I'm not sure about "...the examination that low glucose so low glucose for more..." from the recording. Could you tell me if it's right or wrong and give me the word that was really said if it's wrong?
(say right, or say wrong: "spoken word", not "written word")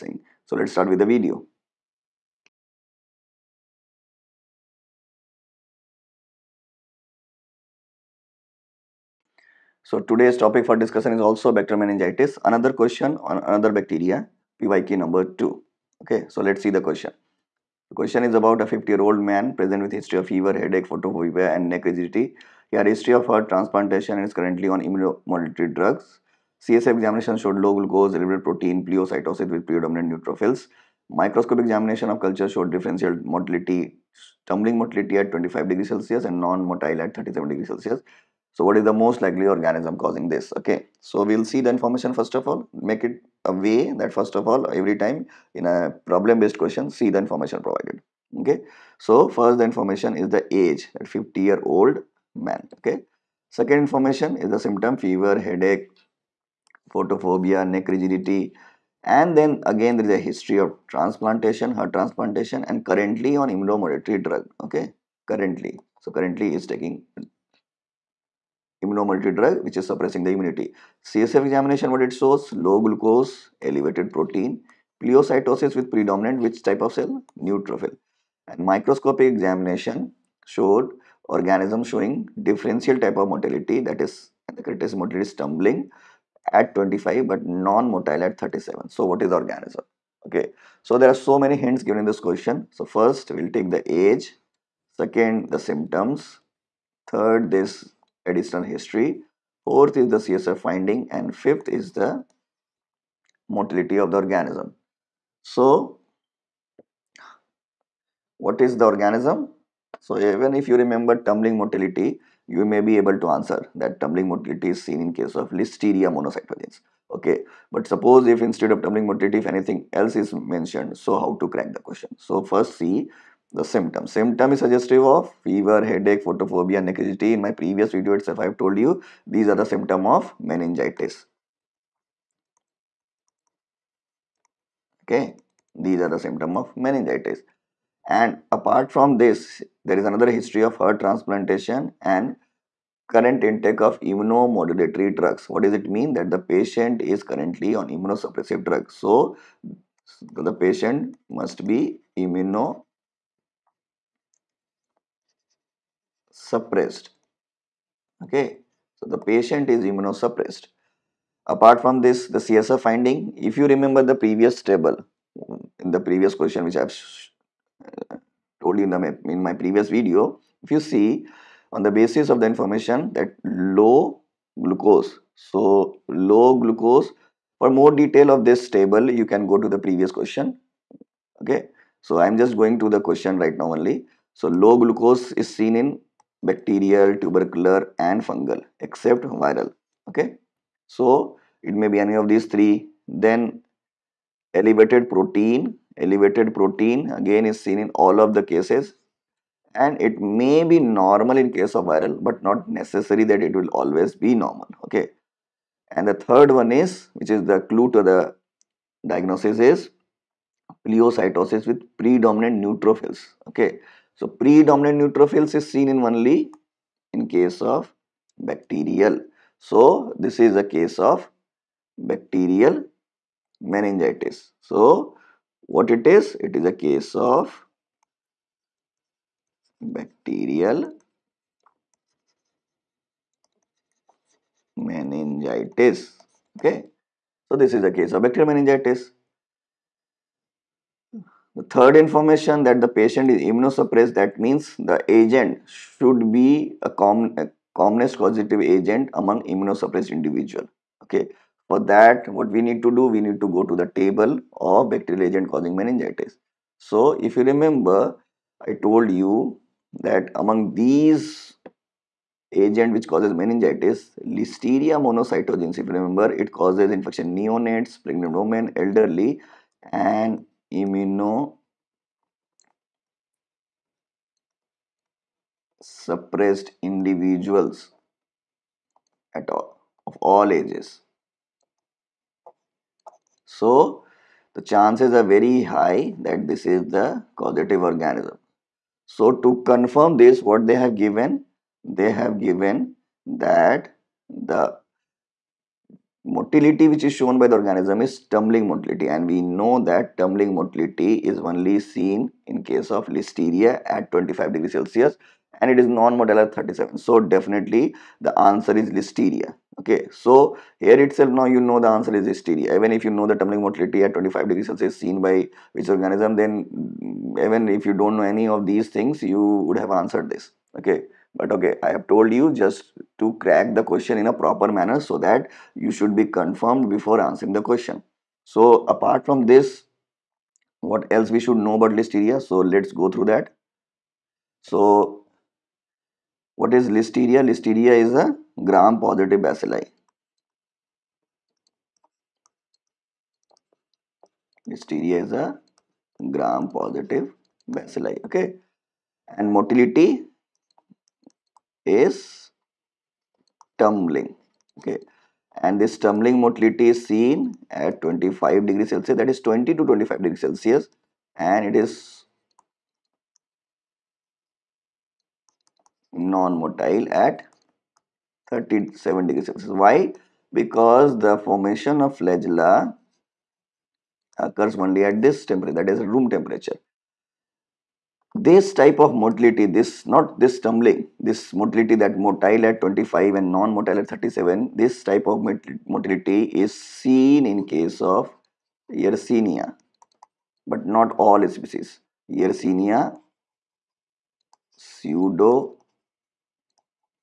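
wrong: "information", not "examination".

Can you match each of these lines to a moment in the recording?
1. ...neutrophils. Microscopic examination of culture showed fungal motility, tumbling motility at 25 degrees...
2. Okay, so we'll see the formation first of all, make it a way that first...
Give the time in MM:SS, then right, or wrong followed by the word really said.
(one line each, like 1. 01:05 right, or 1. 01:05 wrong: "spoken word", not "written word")
1. 00:30 wrong: "differential", not "fungal"
2. 00:40 wrong: "information", not "formation".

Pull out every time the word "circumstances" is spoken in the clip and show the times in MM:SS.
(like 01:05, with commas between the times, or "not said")
not said.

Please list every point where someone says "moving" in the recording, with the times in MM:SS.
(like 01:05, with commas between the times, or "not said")
not said.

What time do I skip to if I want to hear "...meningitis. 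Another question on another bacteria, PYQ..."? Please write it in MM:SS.
00:11.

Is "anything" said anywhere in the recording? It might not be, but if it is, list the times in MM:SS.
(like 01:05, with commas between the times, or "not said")
01:59.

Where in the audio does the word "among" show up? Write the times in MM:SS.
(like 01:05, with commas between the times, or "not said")
04:09, 04:20.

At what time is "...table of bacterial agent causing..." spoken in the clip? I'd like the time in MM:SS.
04:13.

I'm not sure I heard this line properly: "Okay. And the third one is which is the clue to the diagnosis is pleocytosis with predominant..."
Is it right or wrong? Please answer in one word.
right.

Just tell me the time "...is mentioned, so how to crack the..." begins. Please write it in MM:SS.
02:00.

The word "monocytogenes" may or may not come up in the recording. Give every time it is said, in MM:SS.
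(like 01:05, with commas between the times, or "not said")
01:56, 04:25.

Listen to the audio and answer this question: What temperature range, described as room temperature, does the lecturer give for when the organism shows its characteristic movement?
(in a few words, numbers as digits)
20 to 25 degrees Celsius.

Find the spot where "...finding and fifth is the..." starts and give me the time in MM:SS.
01:40.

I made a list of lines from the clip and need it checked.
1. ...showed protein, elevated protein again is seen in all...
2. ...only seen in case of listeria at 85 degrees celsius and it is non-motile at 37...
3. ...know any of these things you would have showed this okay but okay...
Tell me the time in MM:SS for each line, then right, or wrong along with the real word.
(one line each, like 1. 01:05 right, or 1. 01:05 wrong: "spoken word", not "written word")
1. 03:14 wrong: "elevated", not "showed"
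2. 05:01 wrong: "25", not "85"
3. 05:18 wrong: "answered", not "showed".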